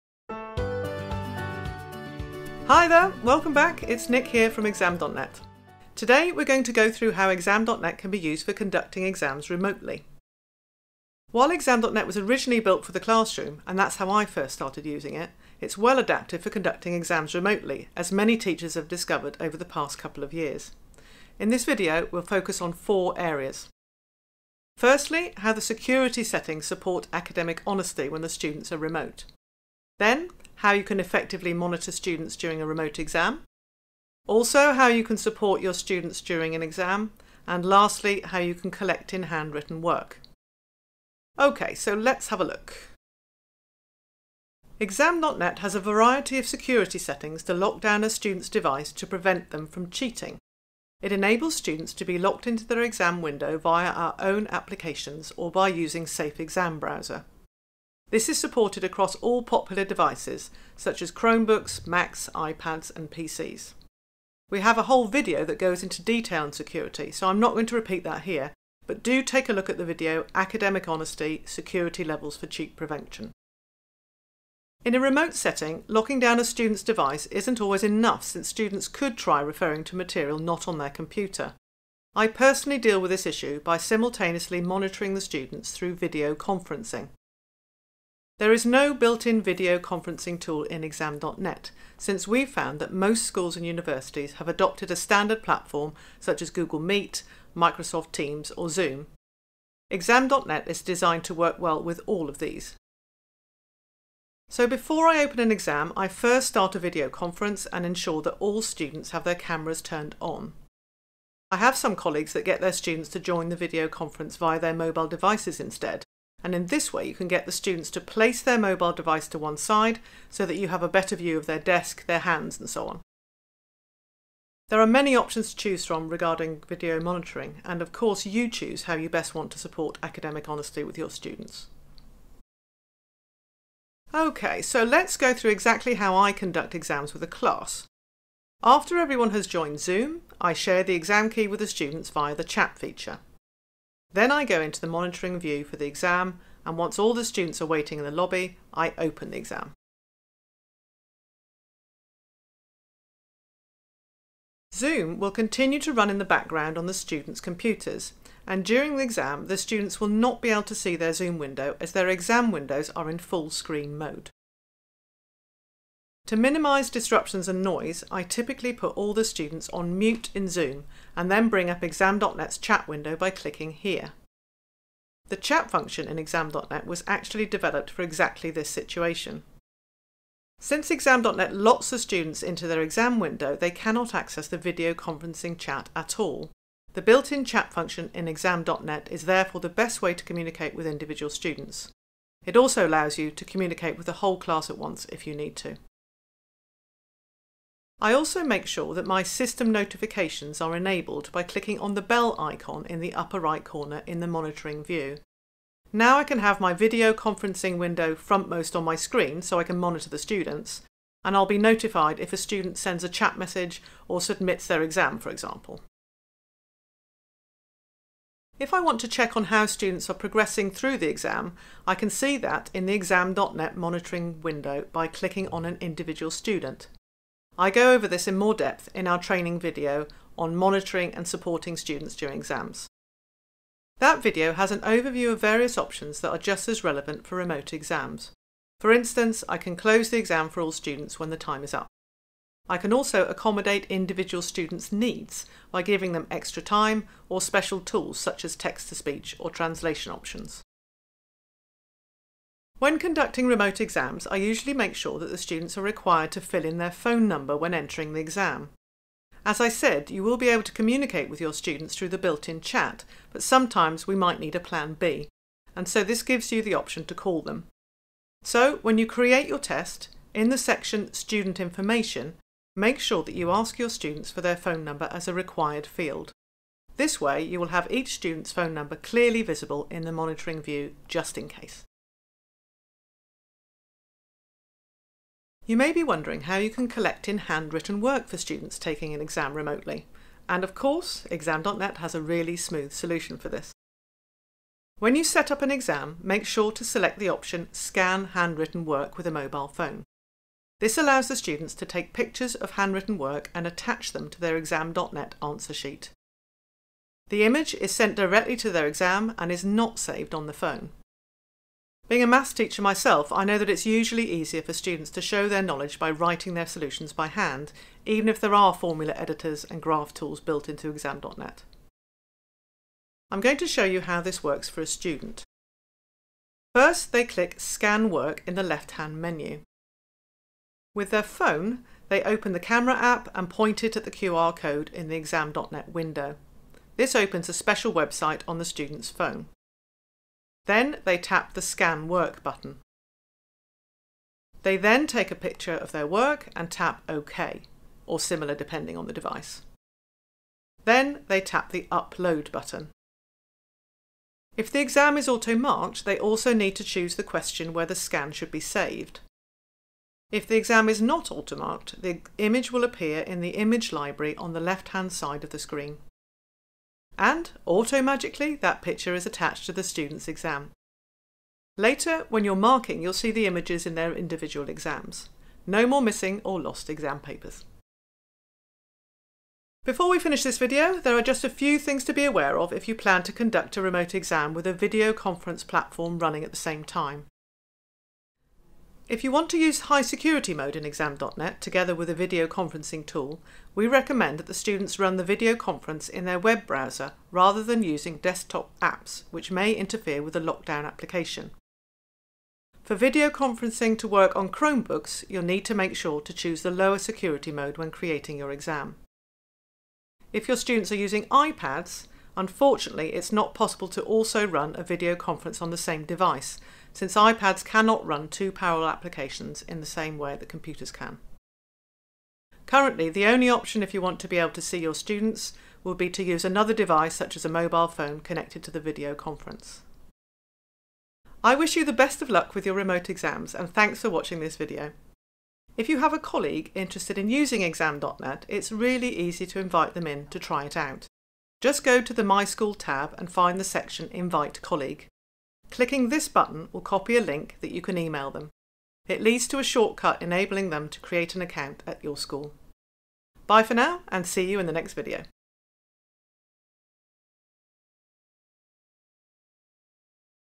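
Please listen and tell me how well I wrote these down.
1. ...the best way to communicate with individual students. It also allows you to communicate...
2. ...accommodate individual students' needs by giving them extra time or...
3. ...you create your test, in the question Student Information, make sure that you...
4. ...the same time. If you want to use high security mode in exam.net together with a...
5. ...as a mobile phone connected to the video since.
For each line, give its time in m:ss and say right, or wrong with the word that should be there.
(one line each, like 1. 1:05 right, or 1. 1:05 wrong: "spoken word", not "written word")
1. 3:09 right
2. 4:03 right
3. 4:28 wrong: "section", not "question"
4. 6:26 right
5. 7:07 wrong: "conference", not "since".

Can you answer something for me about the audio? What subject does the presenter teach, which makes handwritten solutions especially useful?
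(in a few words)
maths.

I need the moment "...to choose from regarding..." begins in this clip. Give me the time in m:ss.
2:05.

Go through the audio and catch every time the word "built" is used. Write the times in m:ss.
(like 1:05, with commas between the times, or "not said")
0:12, 1:28, 3:07, 4:22, 5:20.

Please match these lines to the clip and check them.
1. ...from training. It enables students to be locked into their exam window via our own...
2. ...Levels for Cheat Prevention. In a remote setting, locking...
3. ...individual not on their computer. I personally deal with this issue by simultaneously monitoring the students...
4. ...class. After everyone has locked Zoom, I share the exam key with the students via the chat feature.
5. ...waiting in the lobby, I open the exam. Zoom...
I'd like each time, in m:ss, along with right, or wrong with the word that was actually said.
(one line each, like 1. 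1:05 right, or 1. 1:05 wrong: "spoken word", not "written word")
1. 0:49 wrong: "cheating", not "training"
2. 1:12 right
3. 1:19 wrong: "material", not "individual"
4. 2:17 wrong: "joined", not "locked"
5. 2:27 right.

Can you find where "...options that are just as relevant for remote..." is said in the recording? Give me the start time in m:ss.
3:55.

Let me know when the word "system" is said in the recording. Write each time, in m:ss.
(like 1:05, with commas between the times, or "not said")
3:19.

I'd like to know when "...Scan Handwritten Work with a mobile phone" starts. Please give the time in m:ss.
4:57.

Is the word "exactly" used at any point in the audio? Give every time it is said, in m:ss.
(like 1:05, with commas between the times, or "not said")
2:15, 2:58.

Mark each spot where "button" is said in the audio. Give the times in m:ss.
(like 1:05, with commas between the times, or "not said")
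5:42, 5:52, 7:26.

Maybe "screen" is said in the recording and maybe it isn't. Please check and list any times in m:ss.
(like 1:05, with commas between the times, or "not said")
2:43, 3:28, 6:05.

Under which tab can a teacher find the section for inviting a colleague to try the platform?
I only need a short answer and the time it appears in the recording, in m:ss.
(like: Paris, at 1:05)
My School, at 7:22.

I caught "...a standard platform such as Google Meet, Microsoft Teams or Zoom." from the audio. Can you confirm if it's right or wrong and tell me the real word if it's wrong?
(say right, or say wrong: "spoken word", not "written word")
right.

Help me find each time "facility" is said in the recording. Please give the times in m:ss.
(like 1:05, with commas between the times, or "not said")
not said.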